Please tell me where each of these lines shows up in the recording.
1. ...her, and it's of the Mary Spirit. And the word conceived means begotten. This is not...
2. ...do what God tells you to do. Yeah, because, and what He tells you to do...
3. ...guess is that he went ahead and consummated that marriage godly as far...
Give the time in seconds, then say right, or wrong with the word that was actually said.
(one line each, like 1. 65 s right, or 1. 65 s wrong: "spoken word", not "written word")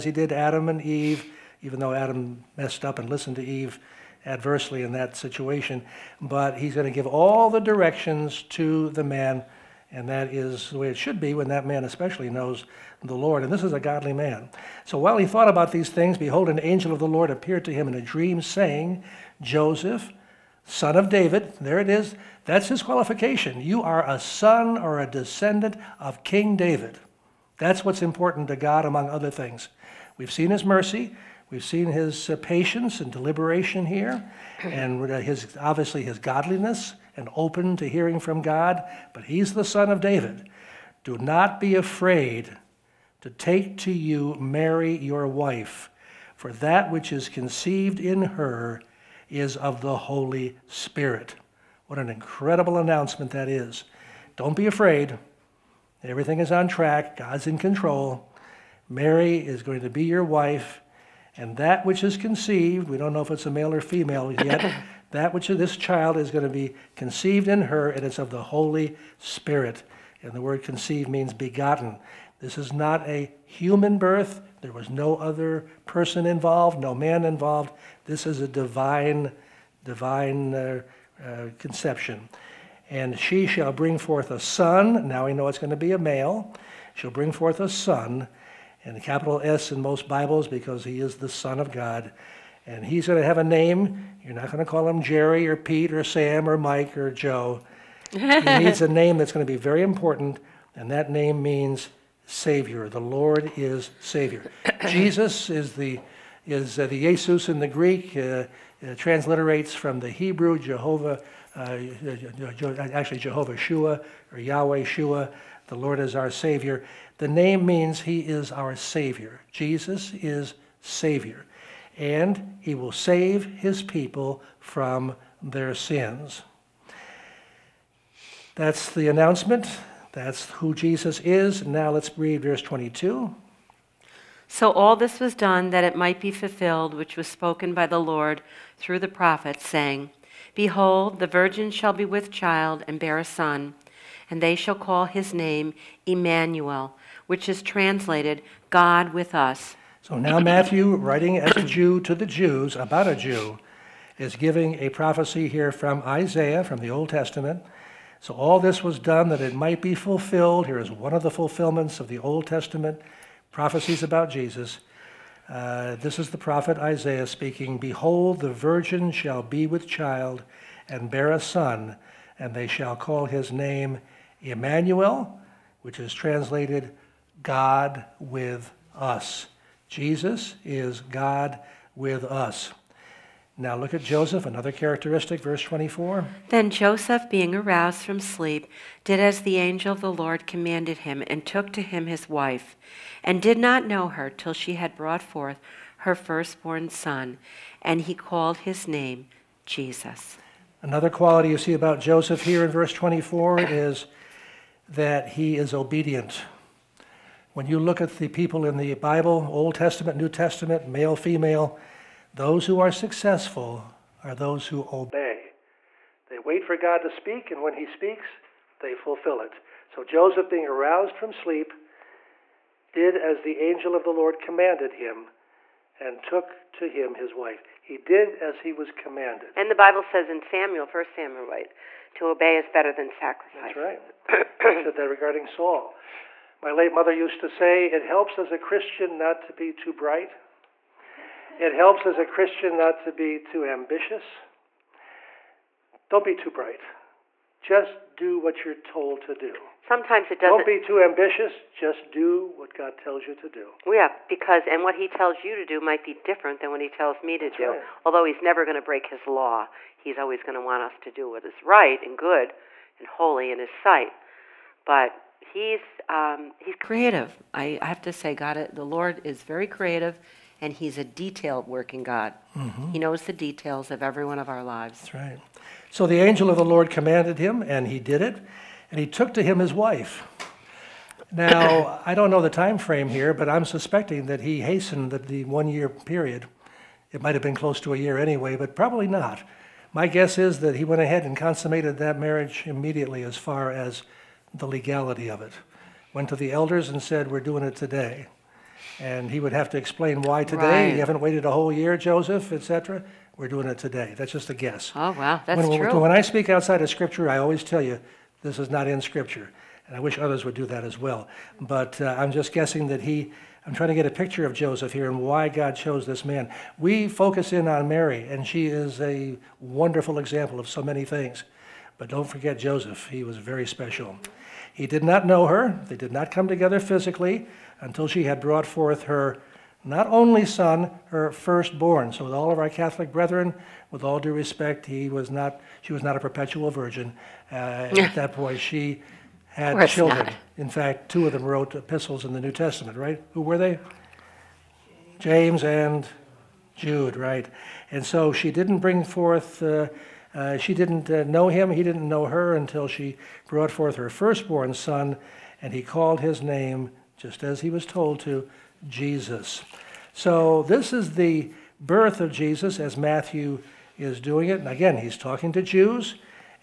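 1. 67 s wrong: "Holy", not "Mary"
2. 252 s right
3. 290 s wrong: "immediately", not "godly".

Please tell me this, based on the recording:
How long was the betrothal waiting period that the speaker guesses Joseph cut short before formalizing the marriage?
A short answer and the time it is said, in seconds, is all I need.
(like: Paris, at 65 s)
1 year, at 285 s.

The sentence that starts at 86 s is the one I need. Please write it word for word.
She'll bring forth a son, and the capital S in most Bibles because he is the Son of God.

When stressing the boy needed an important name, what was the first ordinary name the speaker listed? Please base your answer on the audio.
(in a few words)
Jerry.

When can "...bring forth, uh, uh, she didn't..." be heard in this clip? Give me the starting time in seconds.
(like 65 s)
348 s.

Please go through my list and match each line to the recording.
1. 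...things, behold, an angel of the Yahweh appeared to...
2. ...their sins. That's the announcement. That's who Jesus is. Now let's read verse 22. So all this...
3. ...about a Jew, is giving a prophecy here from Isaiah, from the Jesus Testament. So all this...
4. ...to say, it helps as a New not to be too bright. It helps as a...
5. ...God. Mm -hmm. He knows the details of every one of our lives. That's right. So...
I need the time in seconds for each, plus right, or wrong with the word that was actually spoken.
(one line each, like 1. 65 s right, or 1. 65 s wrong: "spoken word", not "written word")
1. 15 s wrong: "Lord", not "Yahweh"
2. 125 s right
3. 152 s wrong: "Old", not "Jesus"
4. 237 s wrong: "Christian", not "New"
5. 272 s right.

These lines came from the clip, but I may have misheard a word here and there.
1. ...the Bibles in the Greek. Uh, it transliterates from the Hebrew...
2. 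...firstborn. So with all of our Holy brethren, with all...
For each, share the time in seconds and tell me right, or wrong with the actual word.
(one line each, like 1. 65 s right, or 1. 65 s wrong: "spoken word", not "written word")
1. 106 s wrong: "Jesus", not "Bibles"
2. 331 s wrong: "Catholic", not "Holy".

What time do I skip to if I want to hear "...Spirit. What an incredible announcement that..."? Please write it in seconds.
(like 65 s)
50 s.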